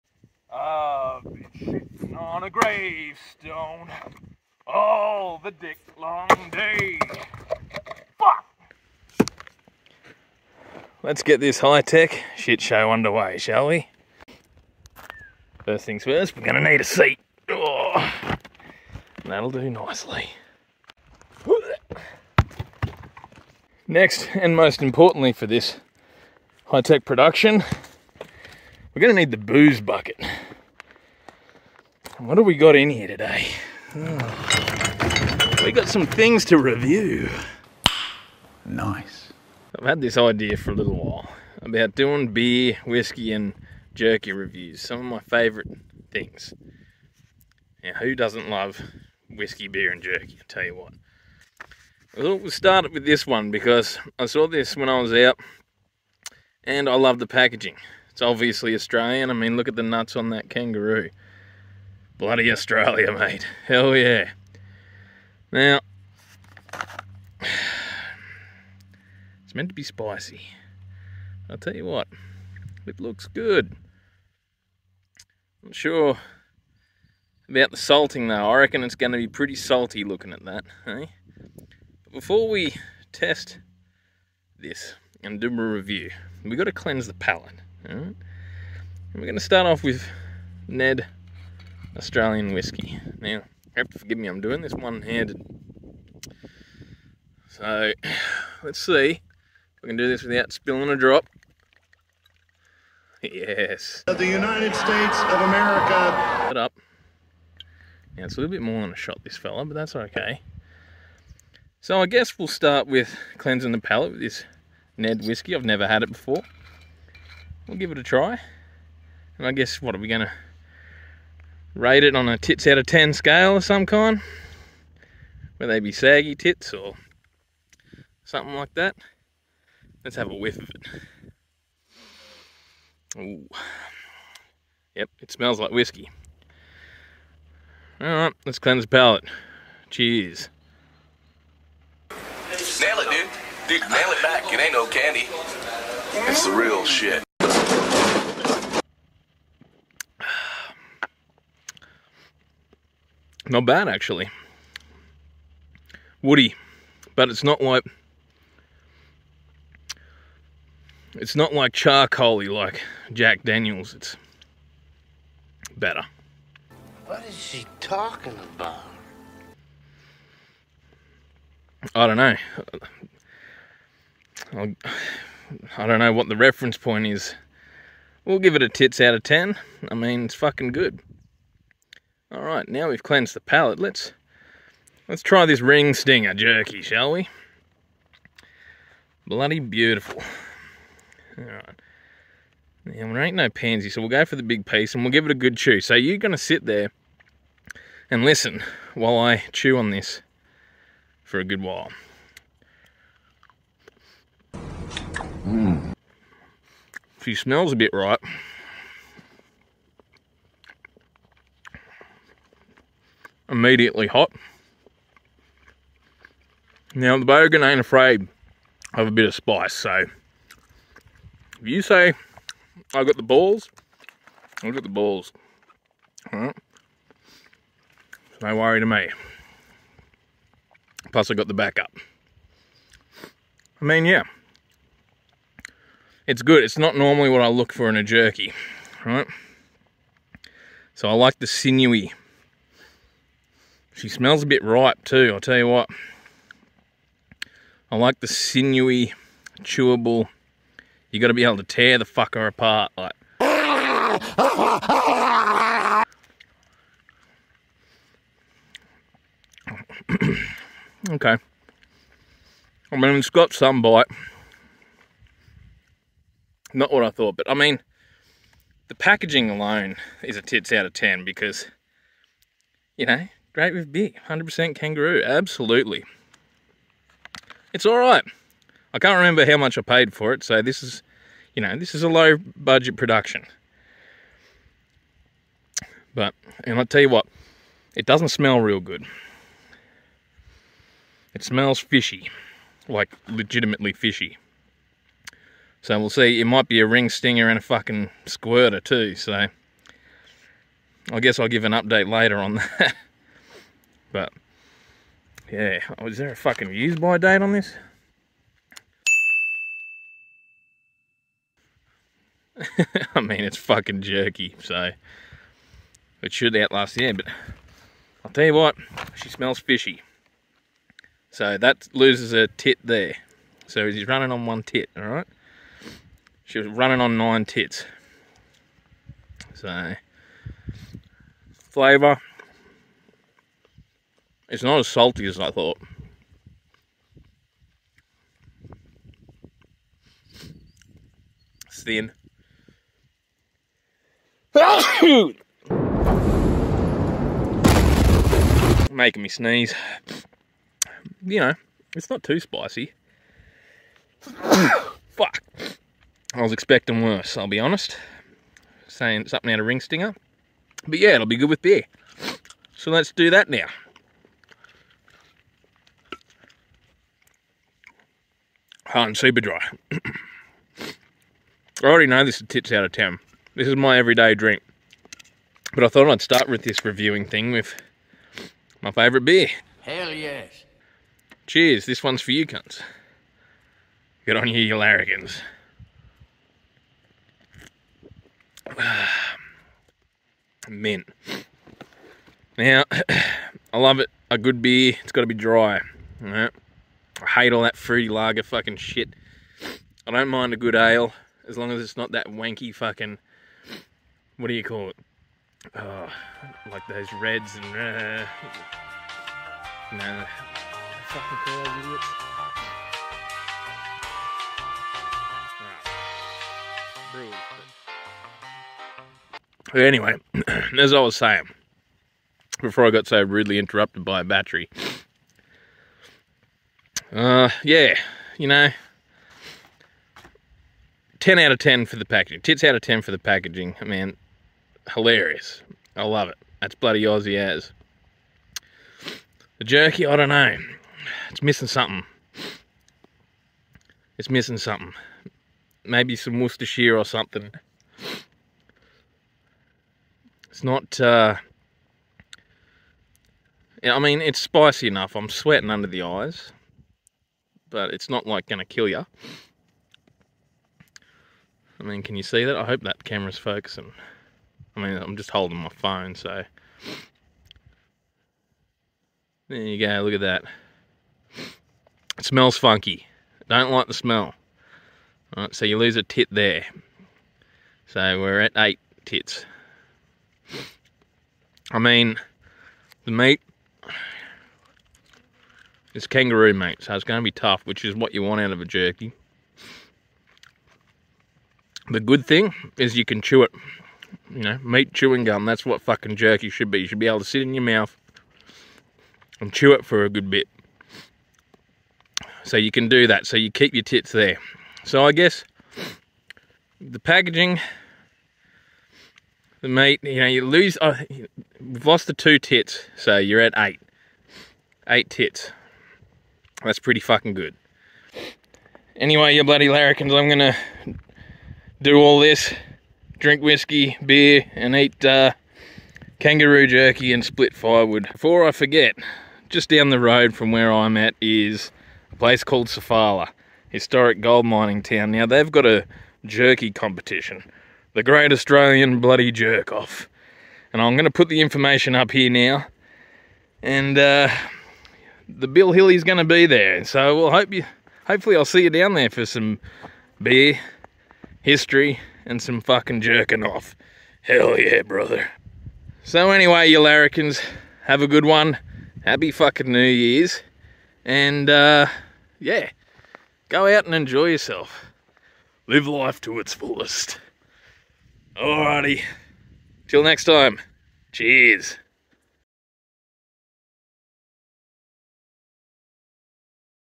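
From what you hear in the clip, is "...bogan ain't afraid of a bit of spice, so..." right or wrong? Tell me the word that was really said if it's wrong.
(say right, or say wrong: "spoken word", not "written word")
right.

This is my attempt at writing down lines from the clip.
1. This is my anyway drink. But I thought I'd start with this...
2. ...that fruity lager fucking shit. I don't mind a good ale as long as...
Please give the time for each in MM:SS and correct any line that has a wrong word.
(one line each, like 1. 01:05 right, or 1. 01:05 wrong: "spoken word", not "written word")
1. 06:13 wrong: "everyday", not "anyway"
2. 06:37 right.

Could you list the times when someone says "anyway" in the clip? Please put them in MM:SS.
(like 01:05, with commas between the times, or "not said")
06:59, 08:38, 09:16.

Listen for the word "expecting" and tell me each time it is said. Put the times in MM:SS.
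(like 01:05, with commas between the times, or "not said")
05:56.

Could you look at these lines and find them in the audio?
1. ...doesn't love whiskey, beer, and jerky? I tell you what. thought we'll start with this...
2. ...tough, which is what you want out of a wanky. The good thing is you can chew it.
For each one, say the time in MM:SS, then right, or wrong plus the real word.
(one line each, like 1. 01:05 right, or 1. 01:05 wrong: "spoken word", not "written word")
1. 00:48 right
2. 08:07 wrong: "jerky", not "wanky".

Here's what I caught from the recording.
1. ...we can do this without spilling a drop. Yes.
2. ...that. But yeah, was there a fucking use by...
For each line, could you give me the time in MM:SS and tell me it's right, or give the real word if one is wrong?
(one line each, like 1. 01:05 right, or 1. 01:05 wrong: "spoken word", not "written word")
1. 01:39 right
2. 05:02 right.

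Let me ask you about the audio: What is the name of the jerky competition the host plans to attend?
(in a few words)
Great Australian Bloody Jerk Off.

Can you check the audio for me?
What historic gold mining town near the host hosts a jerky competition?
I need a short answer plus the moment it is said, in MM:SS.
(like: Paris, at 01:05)
Sofala, at 08:52.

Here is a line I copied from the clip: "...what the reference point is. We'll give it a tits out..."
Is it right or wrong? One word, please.
right.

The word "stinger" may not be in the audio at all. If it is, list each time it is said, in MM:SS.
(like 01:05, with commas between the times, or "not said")
03:05, 04:57, 05:59.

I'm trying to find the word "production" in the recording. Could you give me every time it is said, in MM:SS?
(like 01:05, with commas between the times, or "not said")
00:27, 04:42.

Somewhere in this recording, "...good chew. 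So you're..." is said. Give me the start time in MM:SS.
03:15.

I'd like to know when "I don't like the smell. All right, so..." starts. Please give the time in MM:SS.
07:53.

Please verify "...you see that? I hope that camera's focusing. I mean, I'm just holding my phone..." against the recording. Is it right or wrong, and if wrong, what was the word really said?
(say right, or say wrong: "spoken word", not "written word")
right.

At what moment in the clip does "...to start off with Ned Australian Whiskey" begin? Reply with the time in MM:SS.
01:29.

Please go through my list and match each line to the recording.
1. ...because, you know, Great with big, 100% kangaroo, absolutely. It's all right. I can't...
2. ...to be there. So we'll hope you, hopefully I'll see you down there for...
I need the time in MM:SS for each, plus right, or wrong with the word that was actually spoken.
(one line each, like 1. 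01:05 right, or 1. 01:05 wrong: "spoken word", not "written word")
1. 04:31 right
2. 09:06 right.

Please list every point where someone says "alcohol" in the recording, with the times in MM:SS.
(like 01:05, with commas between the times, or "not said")
not said.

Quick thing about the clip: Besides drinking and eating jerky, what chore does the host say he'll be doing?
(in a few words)
Split firewood.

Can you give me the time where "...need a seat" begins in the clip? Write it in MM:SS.
00:16.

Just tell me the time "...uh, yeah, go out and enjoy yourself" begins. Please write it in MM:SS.
09:21.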